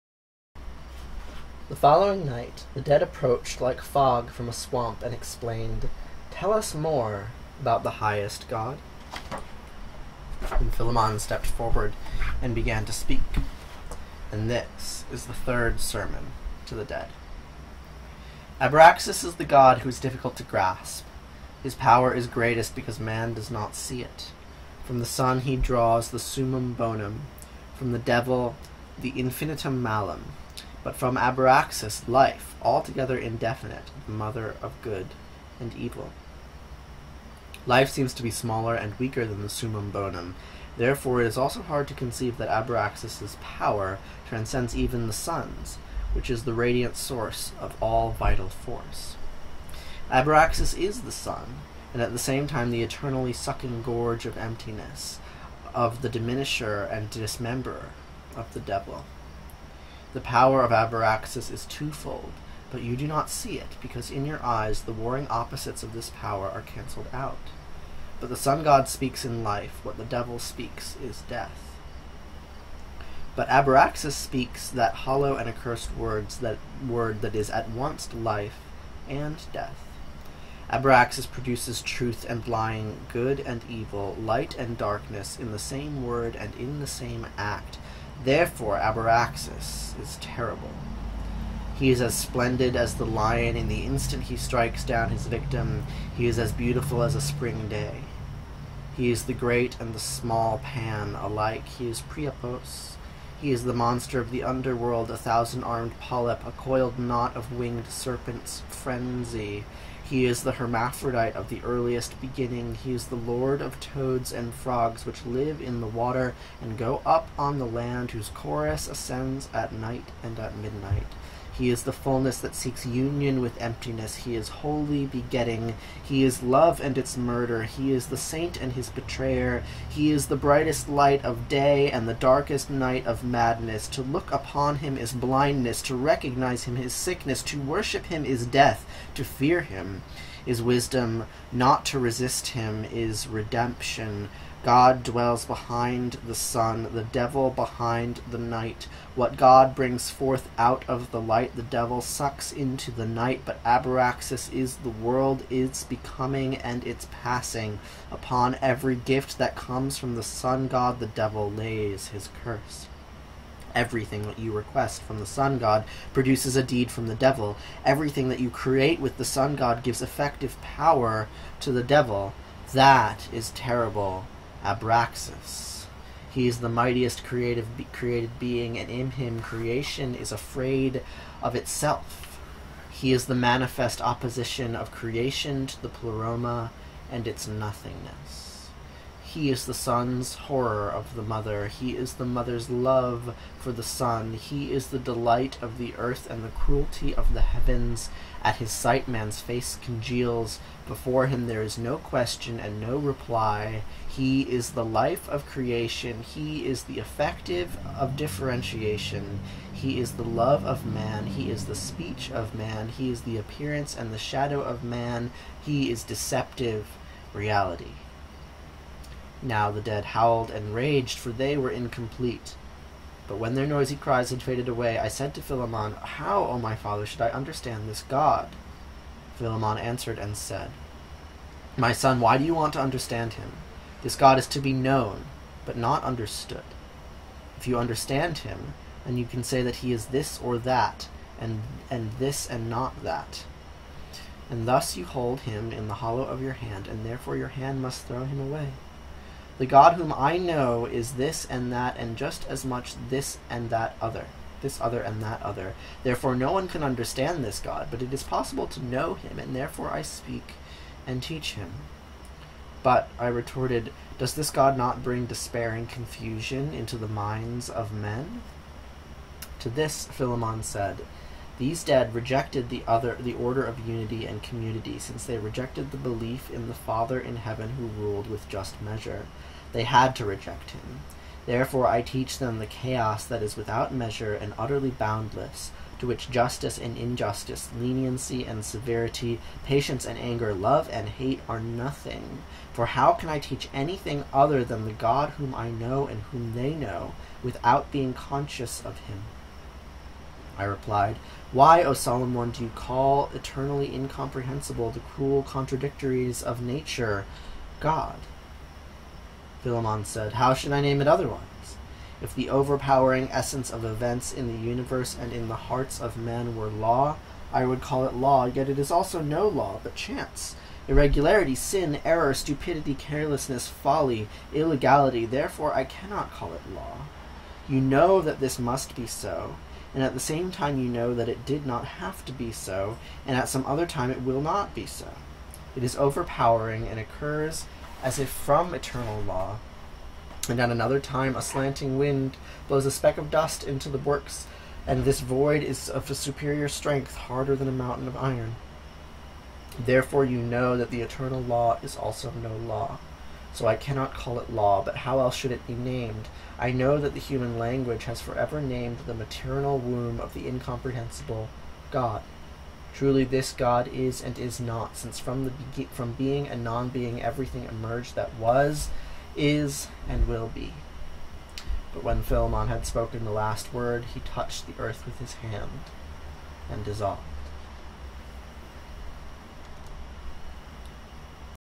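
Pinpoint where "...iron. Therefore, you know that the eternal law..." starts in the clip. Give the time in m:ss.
5:48.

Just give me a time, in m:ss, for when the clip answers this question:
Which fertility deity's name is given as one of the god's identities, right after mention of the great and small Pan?
1:42.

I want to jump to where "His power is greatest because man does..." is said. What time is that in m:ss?
0:21.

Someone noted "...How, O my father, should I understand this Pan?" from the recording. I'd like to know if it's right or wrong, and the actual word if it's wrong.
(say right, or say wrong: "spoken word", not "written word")
wrong: "God", not "Pan".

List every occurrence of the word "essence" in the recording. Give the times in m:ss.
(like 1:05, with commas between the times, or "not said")
5:13.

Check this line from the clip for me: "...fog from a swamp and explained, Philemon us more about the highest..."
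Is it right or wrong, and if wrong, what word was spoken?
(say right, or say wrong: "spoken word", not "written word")
wrong: "Tell", not "Philemon".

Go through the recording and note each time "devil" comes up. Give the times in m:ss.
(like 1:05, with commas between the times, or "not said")
0:27, 0:58, 1:10, 2:27, 2:31, 2:41, 2:47, 2:51.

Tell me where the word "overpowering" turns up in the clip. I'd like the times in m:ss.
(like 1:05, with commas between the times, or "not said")
5:12, 5:35.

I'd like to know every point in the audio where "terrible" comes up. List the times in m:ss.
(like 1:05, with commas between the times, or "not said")
1:30, 2:53.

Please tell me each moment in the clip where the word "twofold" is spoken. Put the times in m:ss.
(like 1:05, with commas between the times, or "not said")
1:01.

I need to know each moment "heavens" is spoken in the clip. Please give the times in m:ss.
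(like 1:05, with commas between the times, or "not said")
3:17, 4:37.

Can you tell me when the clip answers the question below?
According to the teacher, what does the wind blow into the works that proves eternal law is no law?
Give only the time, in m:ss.
5:42.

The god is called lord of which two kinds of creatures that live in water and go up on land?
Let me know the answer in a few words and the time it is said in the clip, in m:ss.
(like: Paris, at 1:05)
toads and frogs, at 1:53.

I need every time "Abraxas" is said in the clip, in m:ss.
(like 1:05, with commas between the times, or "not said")
0:18, 1:00, 1:13, 1:20, 2:54.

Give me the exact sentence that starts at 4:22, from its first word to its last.
But, I retorted, does this God not bring despair and confusion into the minds of men?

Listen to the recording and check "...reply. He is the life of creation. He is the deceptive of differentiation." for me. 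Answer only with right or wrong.
wrong.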